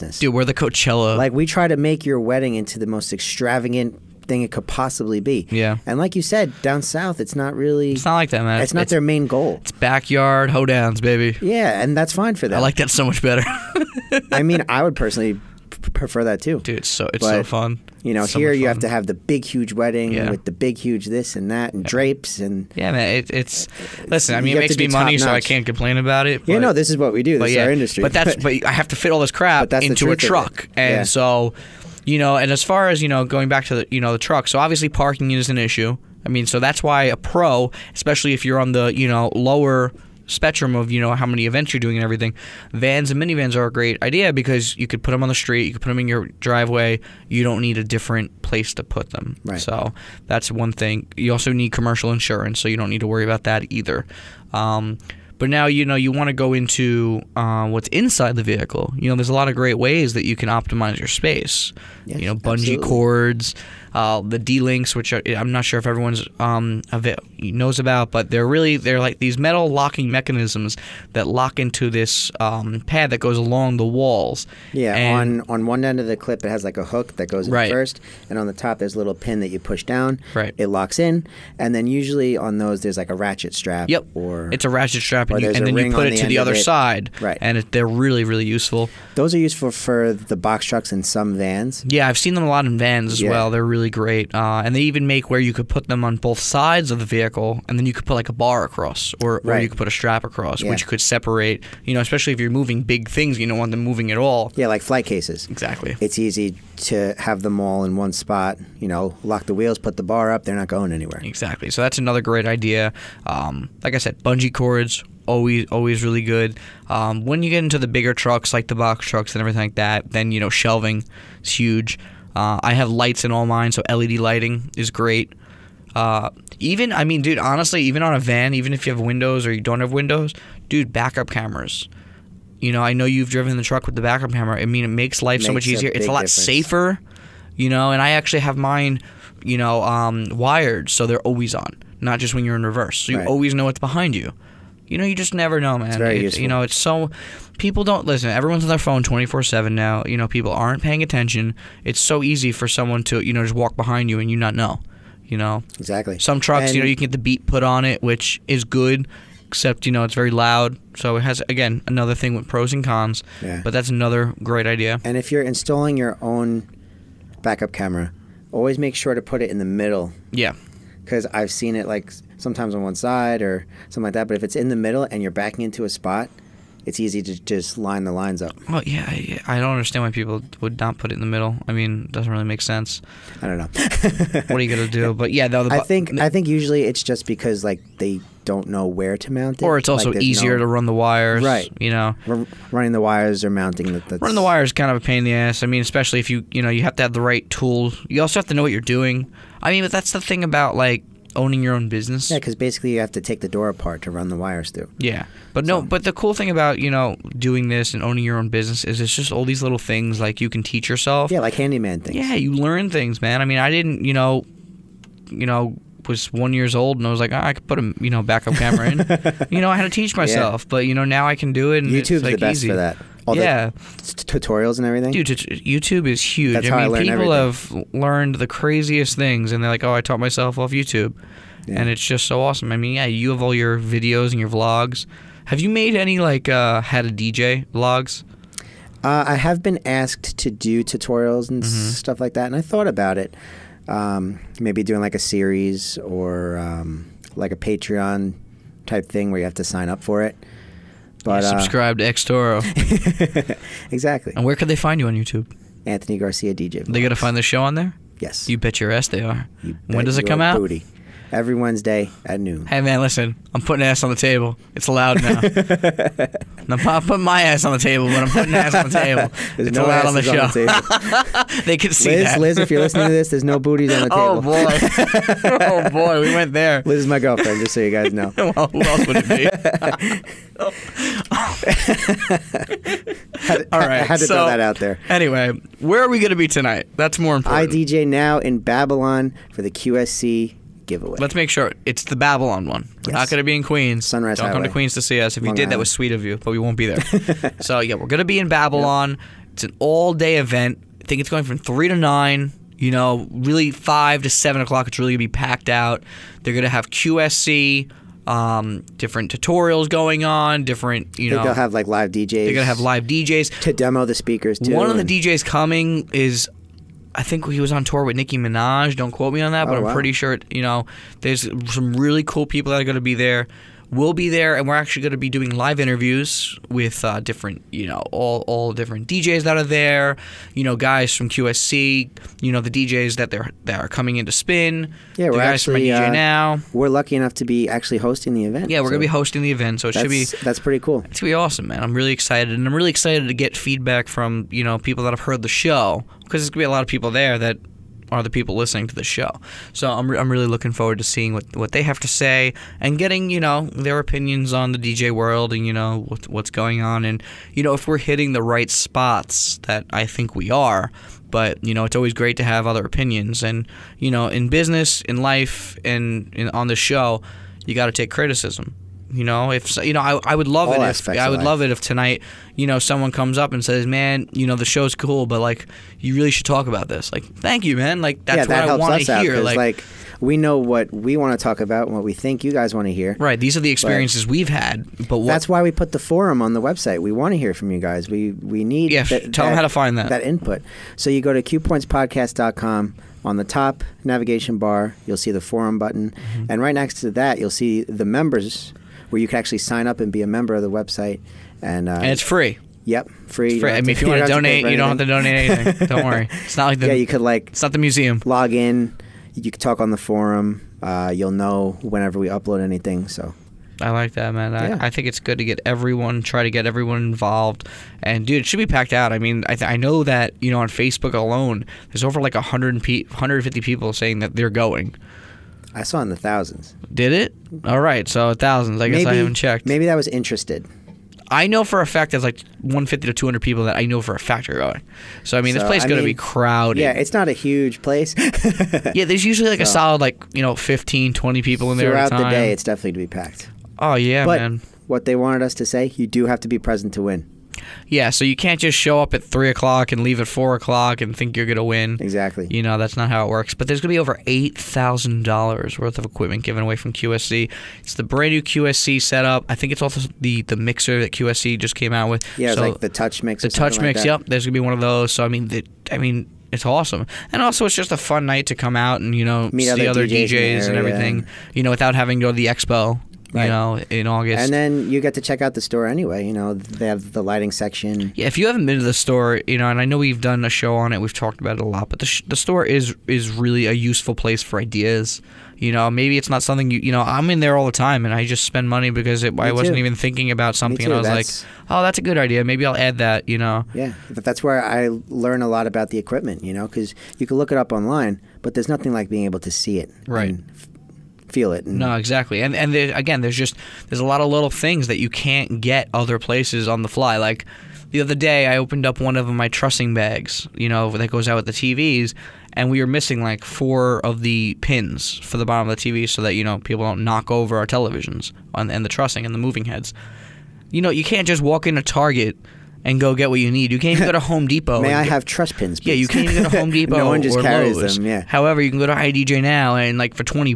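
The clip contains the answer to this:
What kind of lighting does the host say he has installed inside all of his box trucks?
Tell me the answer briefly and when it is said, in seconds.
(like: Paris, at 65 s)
LED lighting, at 123 s.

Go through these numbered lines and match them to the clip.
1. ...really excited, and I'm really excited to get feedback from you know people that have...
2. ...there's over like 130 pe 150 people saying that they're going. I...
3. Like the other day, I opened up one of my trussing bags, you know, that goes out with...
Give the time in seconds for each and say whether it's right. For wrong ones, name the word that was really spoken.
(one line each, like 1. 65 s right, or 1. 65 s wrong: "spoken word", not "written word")
1. 341 s right
2. 421 s wrong: "100", not "130"
3. 507 s right.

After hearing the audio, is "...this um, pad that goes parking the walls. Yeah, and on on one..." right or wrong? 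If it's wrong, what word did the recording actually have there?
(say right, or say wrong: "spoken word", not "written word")
wrong: "along", not "parking".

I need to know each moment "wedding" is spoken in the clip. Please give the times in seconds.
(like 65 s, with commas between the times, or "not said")
2 s, 19 s.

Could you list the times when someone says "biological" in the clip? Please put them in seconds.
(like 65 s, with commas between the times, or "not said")
not said.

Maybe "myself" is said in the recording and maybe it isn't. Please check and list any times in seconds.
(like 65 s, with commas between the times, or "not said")
220 s, 230 s.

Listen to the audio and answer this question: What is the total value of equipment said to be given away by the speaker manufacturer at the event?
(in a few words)
over $8,000.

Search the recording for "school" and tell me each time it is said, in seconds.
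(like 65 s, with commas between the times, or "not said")
not said.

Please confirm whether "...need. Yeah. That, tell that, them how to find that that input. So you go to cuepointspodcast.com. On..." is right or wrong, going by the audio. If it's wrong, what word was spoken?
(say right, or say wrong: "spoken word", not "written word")
right.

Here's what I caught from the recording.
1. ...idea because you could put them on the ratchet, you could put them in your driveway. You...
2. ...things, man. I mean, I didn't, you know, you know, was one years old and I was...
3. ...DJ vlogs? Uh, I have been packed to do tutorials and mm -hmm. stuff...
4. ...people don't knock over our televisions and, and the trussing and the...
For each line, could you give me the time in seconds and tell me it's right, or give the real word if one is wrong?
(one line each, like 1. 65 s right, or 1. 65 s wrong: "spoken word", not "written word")
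1. 44 s wrong: "street", not "ratchet"
2. 212 s right
3. 237 s wrong: "asked", not "packed"
4. 516 s right.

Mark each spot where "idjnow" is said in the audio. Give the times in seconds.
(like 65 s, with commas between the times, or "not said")
287 s, 528 s.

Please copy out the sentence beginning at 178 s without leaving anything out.
Well, yeah, I, I don't understand why people would not put it in the middle.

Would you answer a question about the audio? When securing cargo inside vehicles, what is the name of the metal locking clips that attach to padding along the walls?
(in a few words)
D links.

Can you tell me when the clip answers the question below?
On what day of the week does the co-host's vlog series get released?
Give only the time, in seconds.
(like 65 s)
261 s.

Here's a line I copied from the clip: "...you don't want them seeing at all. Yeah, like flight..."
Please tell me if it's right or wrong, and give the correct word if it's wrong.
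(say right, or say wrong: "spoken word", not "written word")
wrong: "moving", not "seeing".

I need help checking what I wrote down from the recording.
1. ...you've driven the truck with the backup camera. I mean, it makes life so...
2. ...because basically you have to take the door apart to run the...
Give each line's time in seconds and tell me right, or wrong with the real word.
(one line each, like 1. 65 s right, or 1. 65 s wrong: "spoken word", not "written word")
1. 133 s right
2. 202 s right.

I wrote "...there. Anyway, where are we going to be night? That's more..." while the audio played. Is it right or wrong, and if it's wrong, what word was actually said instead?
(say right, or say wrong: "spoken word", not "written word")
wrong: "tonight", not "night".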